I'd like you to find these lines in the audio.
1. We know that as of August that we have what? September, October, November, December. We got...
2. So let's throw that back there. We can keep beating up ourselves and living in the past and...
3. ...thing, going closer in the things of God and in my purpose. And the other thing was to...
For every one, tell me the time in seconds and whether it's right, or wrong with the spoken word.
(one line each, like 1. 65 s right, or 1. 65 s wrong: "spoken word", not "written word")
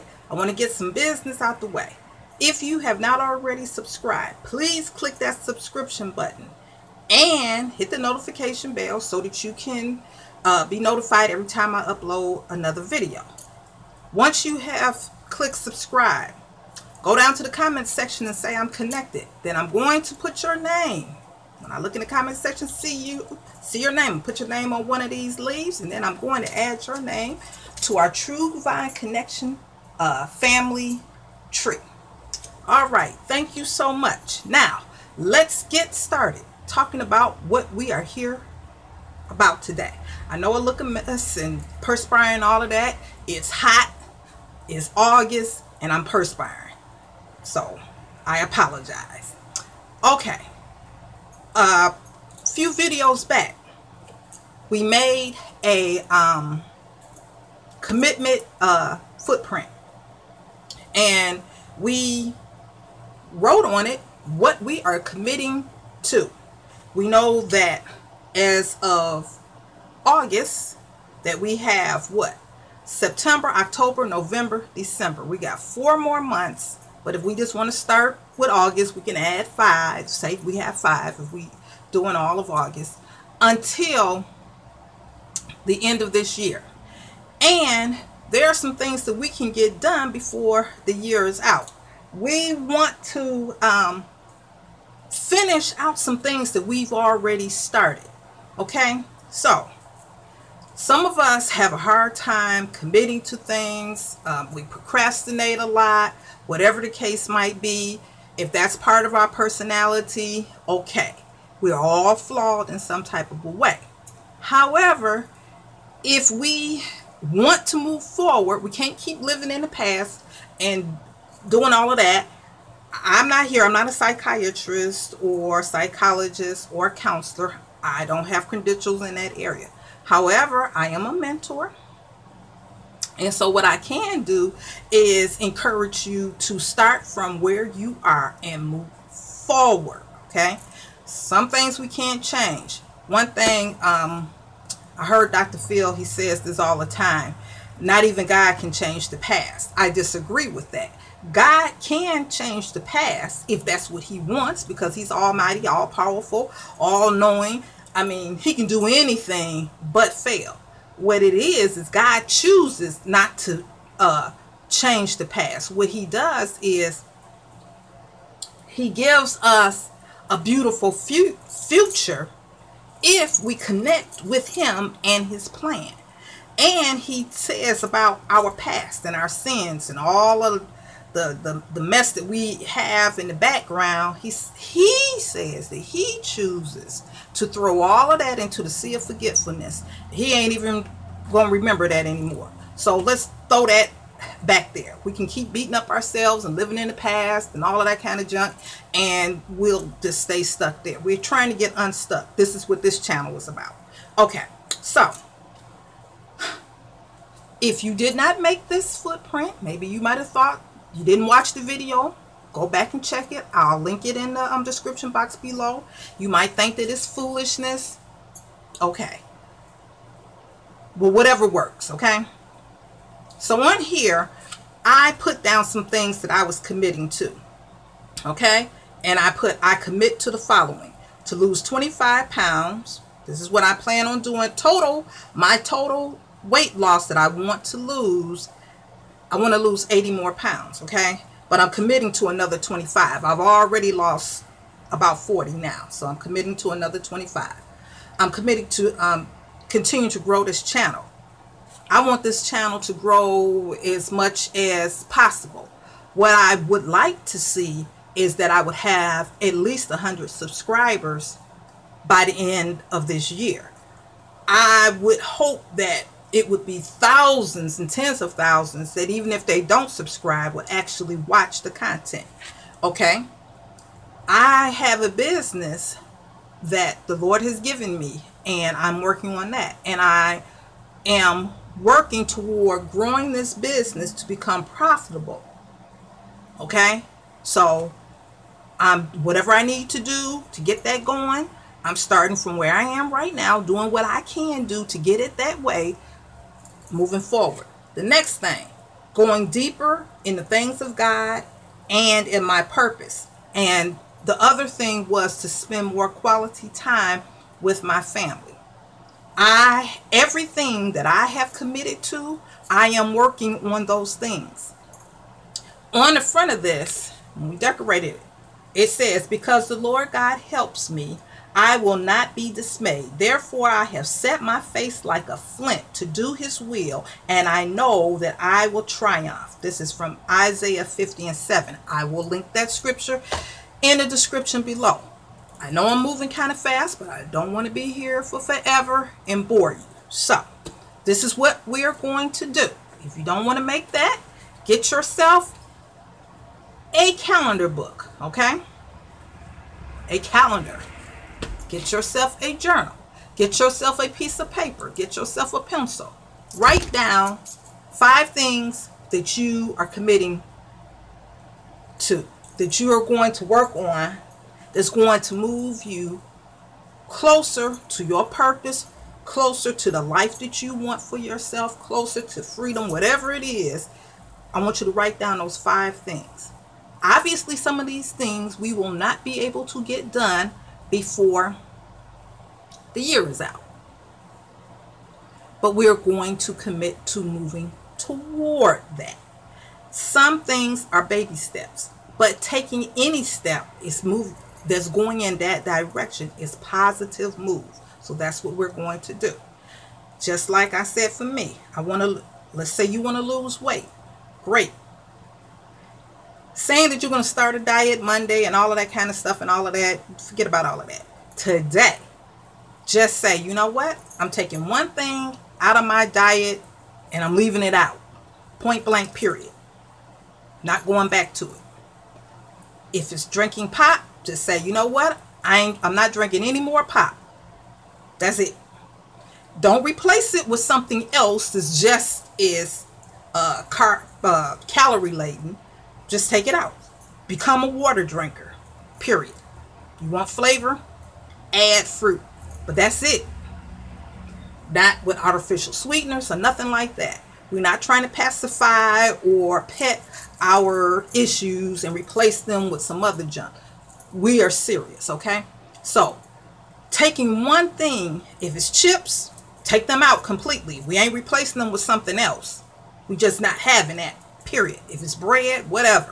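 1. 66 s right
2. 192 s right
3. 298 s wrong: "deeper", not "closer".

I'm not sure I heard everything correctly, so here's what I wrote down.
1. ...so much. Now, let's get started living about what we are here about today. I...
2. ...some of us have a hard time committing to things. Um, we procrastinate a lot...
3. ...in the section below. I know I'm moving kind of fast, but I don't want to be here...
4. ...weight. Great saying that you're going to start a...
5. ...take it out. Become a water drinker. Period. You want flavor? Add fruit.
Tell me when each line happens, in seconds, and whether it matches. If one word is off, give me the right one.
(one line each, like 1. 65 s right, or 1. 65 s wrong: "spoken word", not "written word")
1. 33 s wrong: "talking", not "living"
2. 100 s right
3. 333 s wrong: "description", not "section"
4. 403 s right
5. 436 s right.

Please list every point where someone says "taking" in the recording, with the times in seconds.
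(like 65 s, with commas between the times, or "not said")
392 s, 414 s, 456 s.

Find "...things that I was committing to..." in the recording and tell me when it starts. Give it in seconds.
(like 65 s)
225 s.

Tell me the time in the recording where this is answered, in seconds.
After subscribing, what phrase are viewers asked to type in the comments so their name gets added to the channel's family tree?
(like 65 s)
18 s.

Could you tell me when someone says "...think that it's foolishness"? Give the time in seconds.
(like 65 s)
216 s.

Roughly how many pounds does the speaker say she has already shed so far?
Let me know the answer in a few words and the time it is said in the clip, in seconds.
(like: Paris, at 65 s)
40, at 245 s.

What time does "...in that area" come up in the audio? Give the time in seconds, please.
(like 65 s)
129 s.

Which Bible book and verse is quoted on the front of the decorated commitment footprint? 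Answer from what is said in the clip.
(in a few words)
Isaiah 50:7.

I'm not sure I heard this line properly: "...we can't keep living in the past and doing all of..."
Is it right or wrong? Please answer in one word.
right.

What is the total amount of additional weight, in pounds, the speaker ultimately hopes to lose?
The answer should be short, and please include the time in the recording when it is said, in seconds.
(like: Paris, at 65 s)
80, at 239 s.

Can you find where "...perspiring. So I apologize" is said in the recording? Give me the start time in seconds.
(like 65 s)
46 s.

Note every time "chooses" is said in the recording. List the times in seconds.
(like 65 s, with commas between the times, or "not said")
162 s, 186 s.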